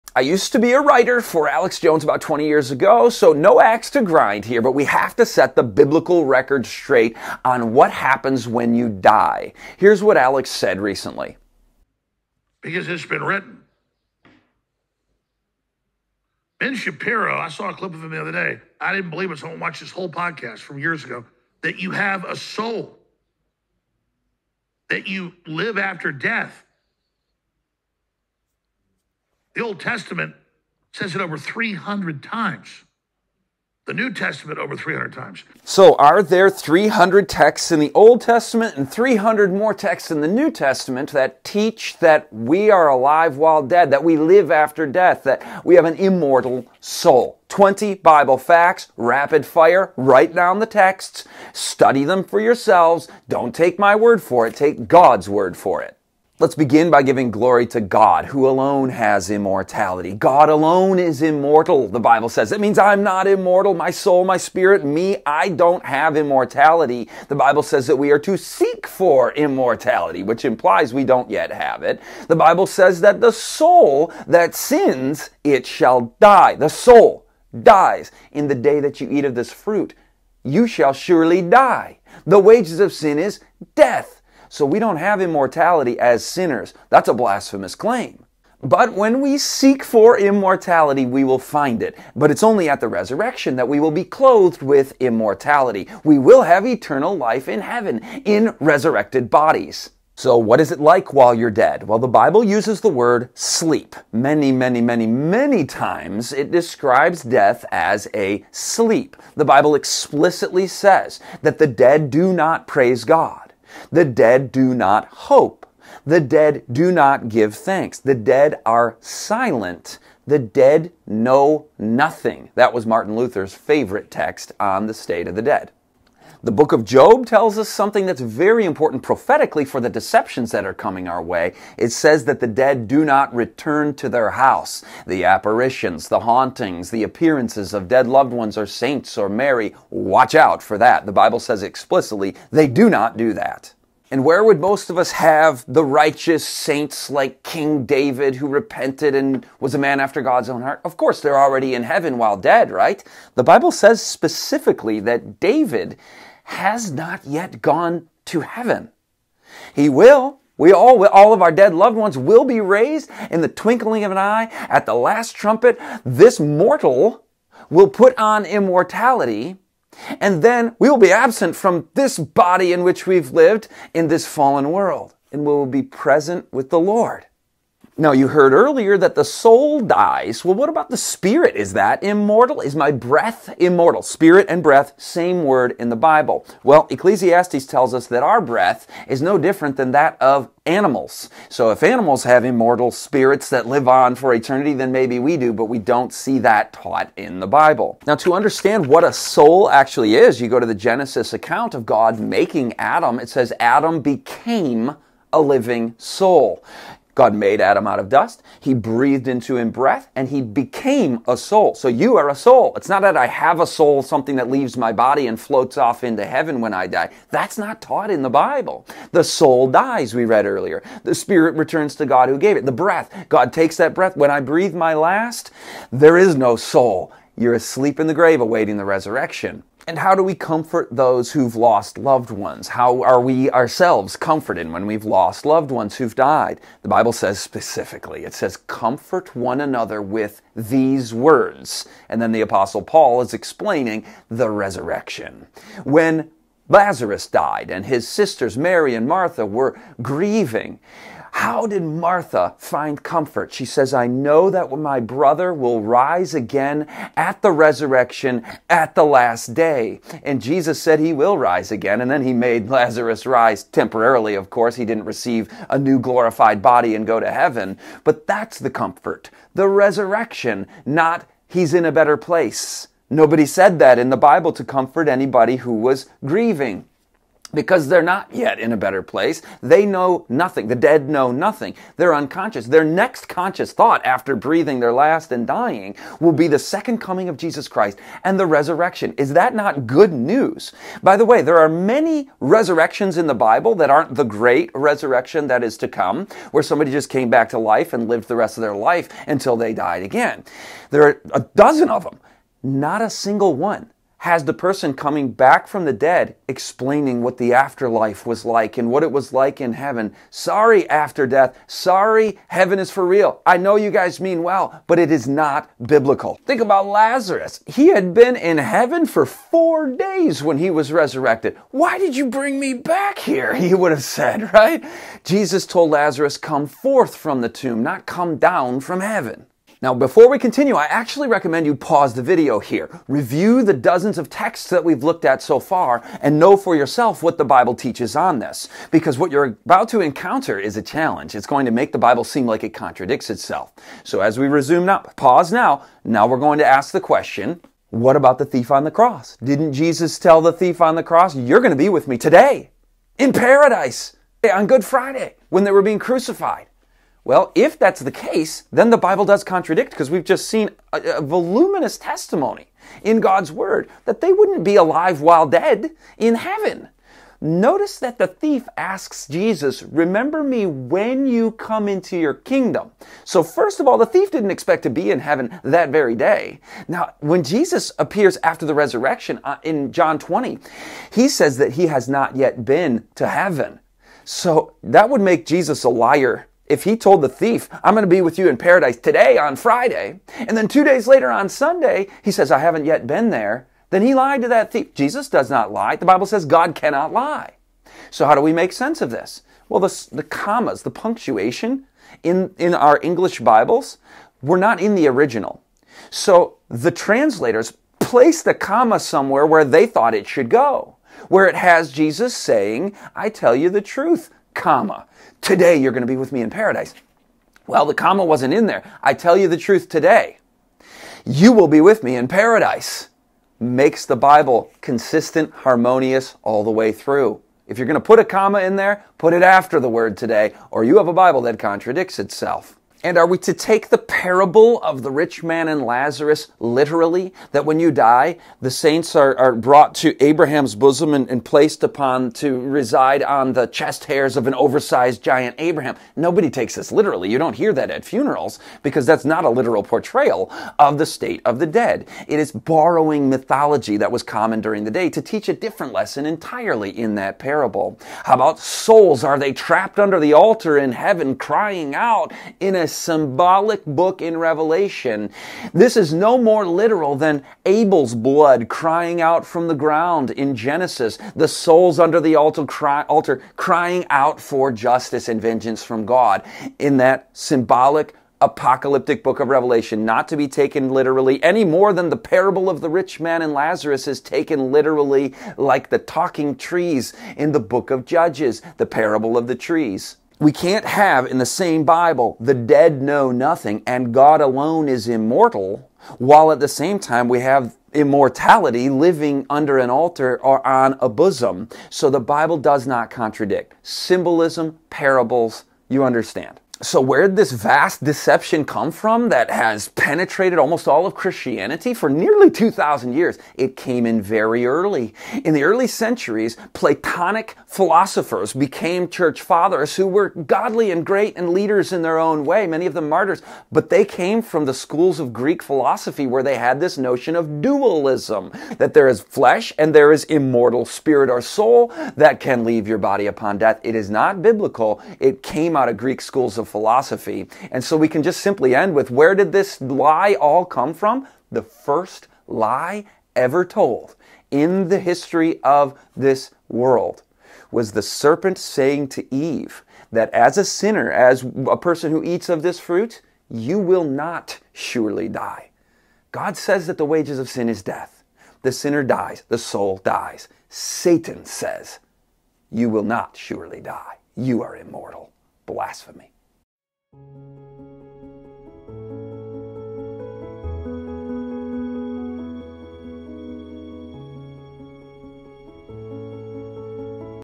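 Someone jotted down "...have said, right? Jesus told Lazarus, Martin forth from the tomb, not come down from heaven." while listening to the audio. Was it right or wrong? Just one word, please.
wrong.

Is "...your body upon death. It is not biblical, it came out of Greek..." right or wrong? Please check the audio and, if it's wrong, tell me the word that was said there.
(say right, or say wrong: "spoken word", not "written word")
right.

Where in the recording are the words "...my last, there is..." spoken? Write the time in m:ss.
3:44.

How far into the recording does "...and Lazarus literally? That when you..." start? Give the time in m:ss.
7:15.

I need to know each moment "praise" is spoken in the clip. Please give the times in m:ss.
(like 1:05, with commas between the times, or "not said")
1:52.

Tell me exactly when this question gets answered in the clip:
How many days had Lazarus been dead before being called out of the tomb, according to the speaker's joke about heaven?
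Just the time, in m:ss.
5:19.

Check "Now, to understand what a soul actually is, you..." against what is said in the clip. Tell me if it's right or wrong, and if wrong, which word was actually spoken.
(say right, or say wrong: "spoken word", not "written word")
right.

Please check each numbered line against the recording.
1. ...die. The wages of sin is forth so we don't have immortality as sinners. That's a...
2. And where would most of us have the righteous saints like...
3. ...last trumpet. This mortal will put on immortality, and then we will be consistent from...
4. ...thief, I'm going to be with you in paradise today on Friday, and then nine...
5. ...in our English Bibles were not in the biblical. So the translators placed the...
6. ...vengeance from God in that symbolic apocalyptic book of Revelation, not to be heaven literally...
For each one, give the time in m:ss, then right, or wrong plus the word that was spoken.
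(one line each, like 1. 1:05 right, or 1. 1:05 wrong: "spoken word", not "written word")
1. 1:21 wrong: "death", not "forth"
2. 2:24 right
3. 2:44 wrong: "absent", not "consistent"
4. 6:27 wrong: "two", not "nine"
5. 6:42 wrong: "original", not "biblical"
6. 7:55 wrong: "taken", not "heaven".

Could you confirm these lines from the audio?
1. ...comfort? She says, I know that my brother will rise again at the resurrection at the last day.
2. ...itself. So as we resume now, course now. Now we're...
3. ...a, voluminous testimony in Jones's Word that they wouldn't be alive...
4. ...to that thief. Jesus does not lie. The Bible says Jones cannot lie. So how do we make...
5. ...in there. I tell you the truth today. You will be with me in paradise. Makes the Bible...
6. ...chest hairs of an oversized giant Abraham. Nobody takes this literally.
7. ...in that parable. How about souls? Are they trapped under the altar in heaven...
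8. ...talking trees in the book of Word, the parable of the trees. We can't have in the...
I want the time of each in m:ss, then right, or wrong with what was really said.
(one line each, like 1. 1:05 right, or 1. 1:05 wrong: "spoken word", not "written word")
1. 4:13 right
2. 5:43 wrong: "pause", not "course"
3. 6:01 wrong: "God", not "Jones"
4. 6:34 wrong: "God", not "Jones"
5. 6:58 right
6. 7:23 right
7. 7:36 right
8. 8:05 wrong: "Judges", not "Word".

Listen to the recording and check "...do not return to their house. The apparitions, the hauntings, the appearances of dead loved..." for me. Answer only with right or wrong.
right.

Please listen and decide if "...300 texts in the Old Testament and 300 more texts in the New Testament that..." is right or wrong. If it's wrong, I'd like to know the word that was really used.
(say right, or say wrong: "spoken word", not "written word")
right.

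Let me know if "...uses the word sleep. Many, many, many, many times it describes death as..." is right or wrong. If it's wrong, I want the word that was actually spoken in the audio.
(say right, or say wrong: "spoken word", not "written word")
right.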